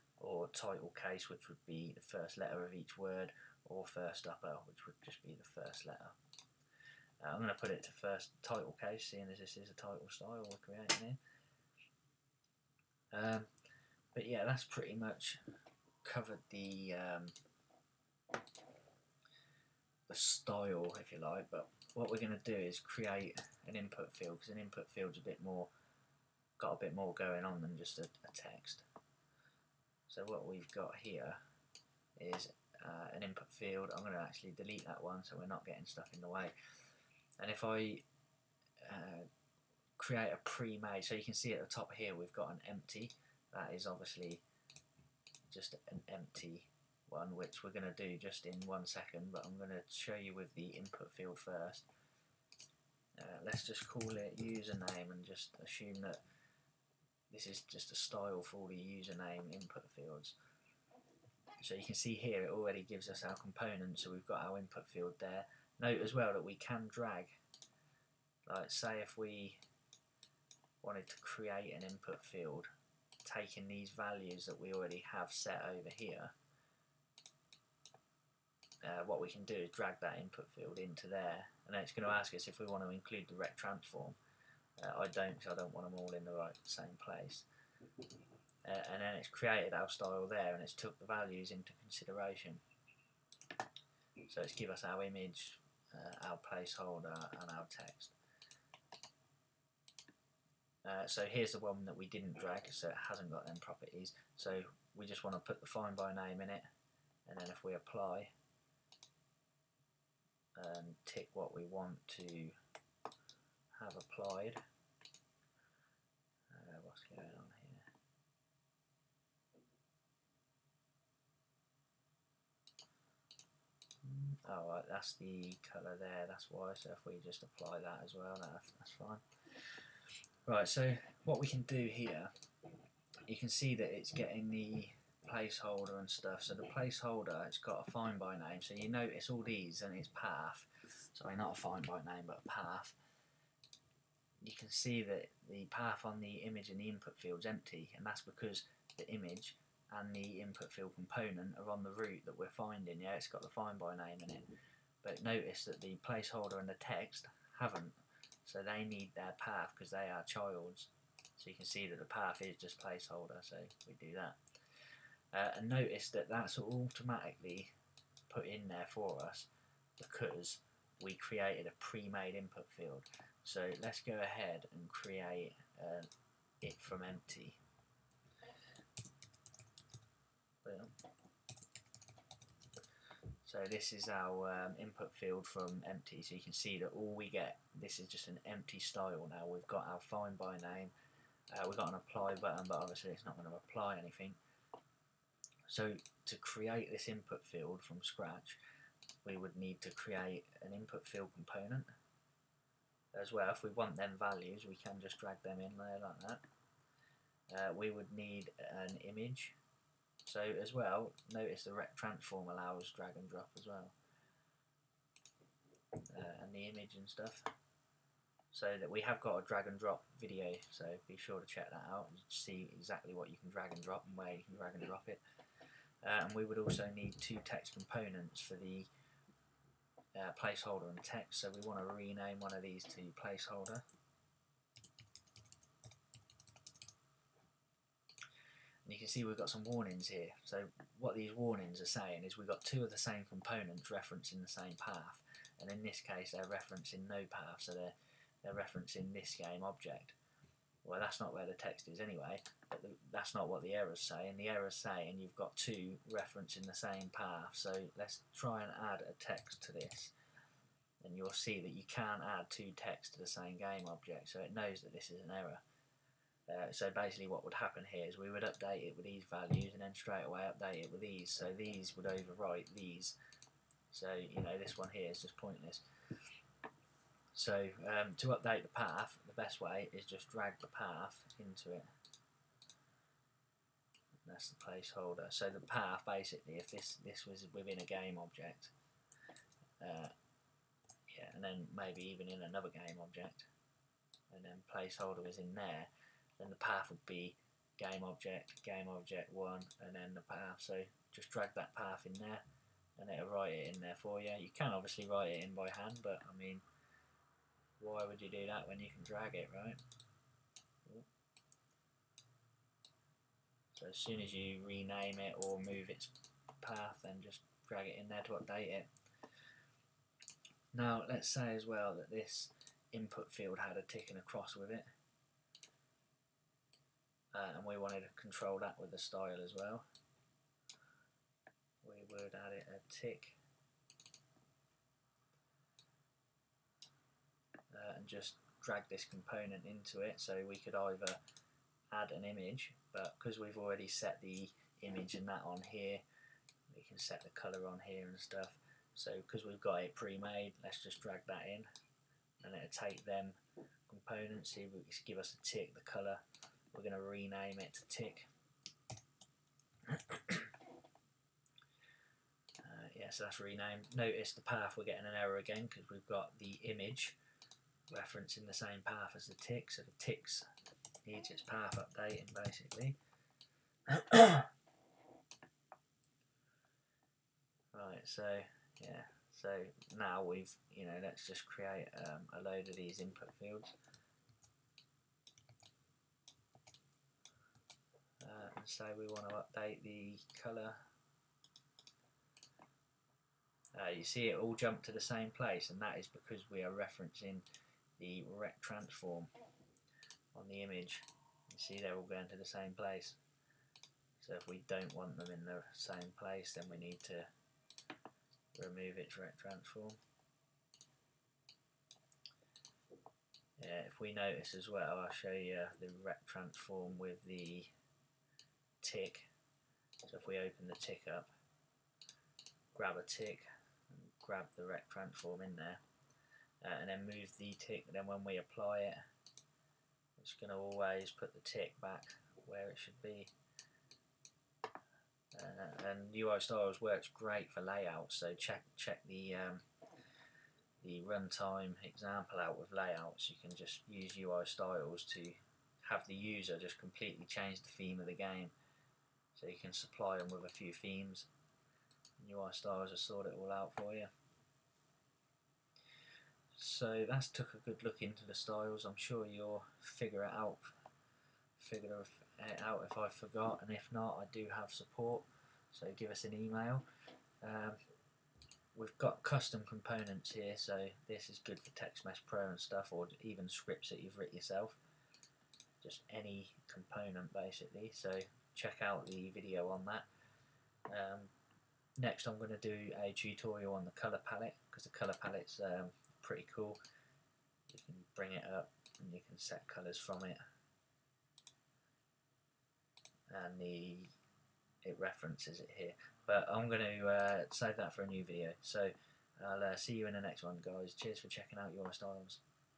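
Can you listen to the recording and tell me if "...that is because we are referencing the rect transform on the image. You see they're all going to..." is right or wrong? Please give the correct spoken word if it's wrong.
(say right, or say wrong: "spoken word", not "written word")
right.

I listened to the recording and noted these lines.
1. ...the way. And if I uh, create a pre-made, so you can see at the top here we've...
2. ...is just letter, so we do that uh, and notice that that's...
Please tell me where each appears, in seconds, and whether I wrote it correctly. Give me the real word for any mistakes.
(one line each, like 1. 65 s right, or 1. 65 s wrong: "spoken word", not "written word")
1. 36 s right
2. 162 s wrong: "placeholder", not "letter".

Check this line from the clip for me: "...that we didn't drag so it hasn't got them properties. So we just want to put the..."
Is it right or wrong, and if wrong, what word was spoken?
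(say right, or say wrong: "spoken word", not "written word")
right.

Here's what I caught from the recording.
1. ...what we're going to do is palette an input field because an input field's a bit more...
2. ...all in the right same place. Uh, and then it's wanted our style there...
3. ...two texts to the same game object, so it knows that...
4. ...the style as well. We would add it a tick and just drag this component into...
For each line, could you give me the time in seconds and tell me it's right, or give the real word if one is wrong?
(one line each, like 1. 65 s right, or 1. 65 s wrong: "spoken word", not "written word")
1. 21 s wrong: "create", not "palette"
2. 85 s wrong: "created", not "wanted"
3. 262 s right
4. 328 s right.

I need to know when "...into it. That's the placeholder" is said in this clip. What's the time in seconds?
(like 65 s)
281 s.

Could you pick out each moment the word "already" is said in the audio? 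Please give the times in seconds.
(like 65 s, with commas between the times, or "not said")
62 s, 74 s, 343 s.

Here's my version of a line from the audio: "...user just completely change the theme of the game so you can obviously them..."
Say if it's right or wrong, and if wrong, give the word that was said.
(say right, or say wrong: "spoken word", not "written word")
wrong: "supply", not "obviously".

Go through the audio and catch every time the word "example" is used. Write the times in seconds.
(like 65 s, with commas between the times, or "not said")
441 s.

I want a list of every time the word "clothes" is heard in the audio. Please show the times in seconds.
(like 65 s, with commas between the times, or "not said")
not said.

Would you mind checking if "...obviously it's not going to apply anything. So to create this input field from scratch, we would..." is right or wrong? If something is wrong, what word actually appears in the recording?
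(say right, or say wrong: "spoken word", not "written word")
right.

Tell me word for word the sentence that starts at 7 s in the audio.
Uh, I'm going to put it to first title case, seeing as this is a title style we're creating here.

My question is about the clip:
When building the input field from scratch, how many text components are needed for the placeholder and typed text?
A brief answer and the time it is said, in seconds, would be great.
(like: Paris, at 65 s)
2, at 227 s.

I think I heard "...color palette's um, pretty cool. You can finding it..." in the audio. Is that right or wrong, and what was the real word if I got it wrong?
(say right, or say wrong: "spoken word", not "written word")
wrong: "bring", not "finding".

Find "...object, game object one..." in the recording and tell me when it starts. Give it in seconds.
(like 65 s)
298 s.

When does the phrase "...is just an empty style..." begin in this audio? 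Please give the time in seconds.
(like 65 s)
187 s.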